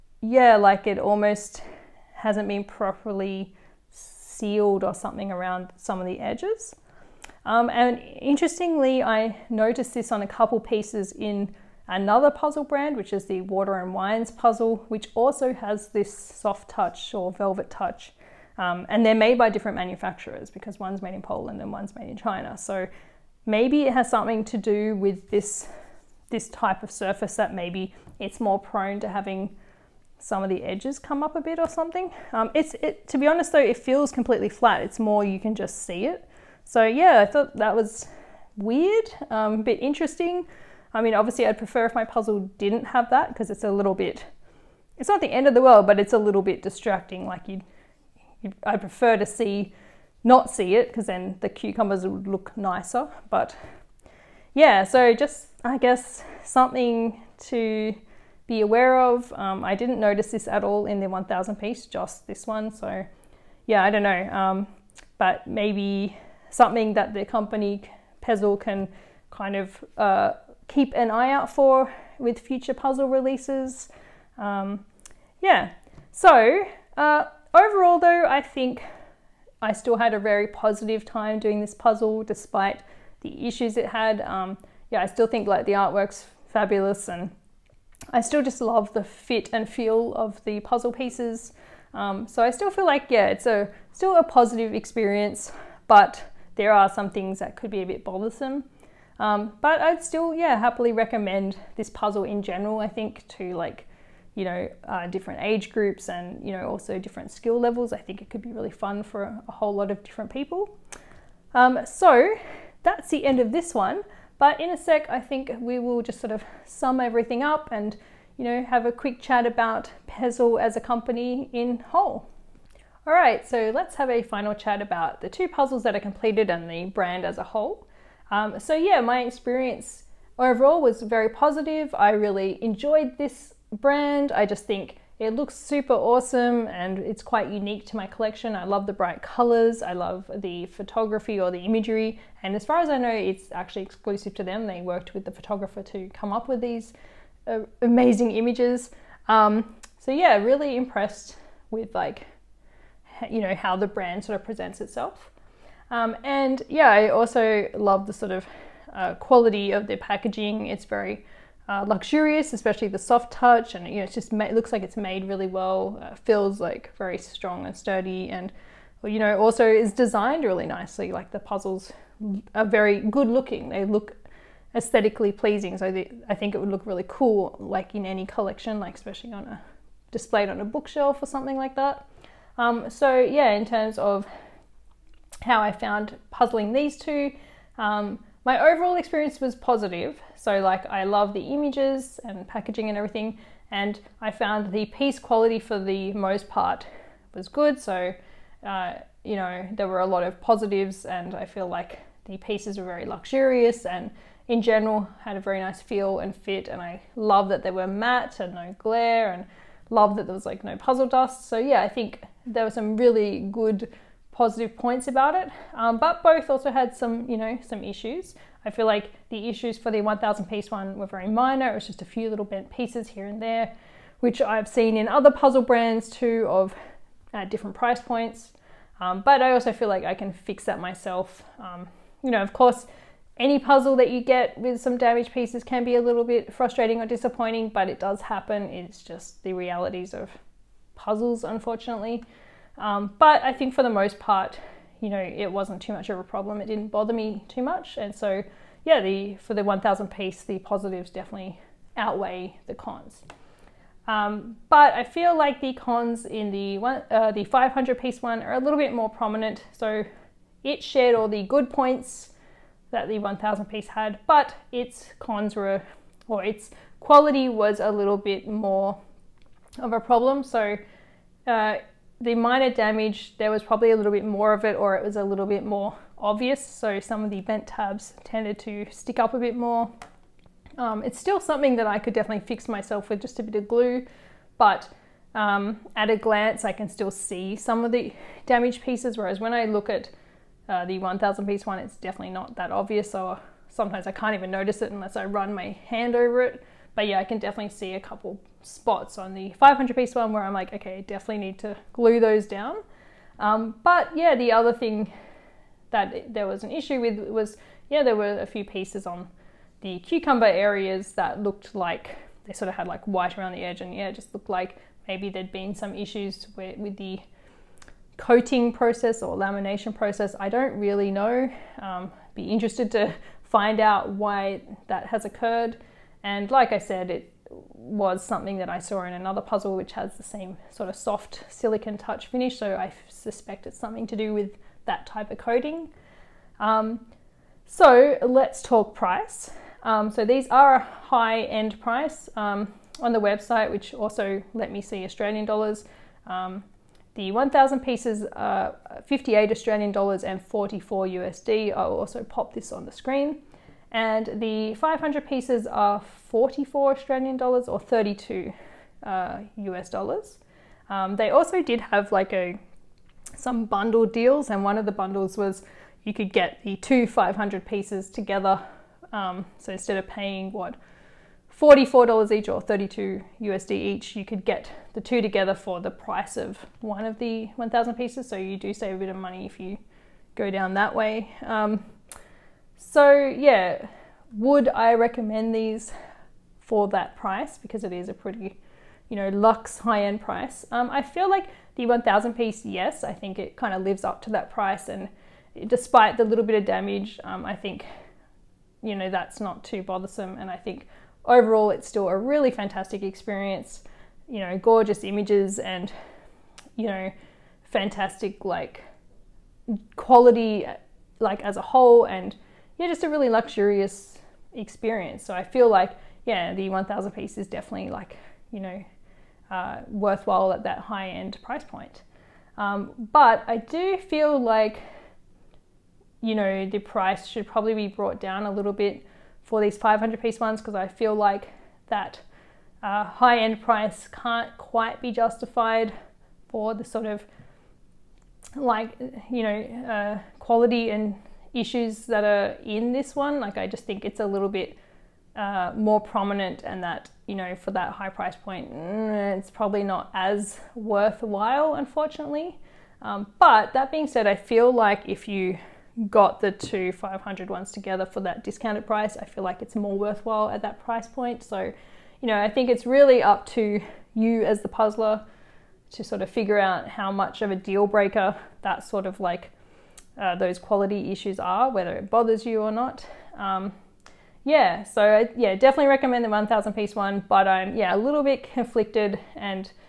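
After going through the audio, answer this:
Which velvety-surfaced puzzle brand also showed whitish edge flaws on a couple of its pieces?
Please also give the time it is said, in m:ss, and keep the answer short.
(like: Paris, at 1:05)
Water and Wines, at 0:13.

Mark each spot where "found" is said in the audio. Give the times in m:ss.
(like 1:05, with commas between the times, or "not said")
3:05, 3:14.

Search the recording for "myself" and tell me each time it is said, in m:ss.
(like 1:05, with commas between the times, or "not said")
3:50, 4:42.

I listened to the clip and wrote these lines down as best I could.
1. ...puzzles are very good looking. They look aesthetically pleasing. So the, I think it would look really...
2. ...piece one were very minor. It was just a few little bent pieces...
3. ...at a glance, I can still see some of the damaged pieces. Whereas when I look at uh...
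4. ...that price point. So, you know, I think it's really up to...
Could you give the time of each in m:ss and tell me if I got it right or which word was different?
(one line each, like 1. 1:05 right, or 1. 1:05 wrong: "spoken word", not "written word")
1. 2:51 right
2. 3:40 right
3. 4:45 right
4. 7:40 right.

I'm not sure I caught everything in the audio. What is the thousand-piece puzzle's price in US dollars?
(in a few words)
44.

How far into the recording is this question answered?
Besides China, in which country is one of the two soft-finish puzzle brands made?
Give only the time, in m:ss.
0:21.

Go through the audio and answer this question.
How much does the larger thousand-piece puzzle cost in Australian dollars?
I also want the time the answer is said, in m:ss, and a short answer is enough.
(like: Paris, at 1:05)
58, at 5:49.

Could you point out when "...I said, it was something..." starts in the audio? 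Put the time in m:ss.
5:26.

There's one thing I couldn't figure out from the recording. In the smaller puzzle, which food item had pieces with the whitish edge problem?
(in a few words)
cucumbers.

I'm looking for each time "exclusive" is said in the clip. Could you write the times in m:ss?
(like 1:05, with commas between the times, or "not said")
2:23.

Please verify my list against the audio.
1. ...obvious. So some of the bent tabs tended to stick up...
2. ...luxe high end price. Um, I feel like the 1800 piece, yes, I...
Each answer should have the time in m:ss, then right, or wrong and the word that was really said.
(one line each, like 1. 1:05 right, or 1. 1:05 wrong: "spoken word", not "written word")
1. 4:36 right
2. 6:29 wrong: "1000", not "1800".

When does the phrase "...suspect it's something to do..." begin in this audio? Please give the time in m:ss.
5:33.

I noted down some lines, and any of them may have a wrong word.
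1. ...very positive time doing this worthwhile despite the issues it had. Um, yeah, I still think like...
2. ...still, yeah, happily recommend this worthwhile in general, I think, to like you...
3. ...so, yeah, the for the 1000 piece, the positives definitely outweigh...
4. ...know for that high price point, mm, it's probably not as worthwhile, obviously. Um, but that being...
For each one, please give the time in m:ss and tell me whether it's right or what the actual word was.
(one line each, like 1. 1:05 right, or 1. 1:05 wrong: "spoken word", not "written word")
1. 1:20 wrong: "puzzle", not "worthwhile"
2. 1:40 wrong: "puzzle", not "worthwhile"
3. 4:08 right
4. 7:27 wrong: "unfortunately", not "obviously".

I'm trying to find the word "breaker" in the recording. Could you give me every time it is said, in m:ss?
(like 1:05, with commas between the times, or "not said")
7:47.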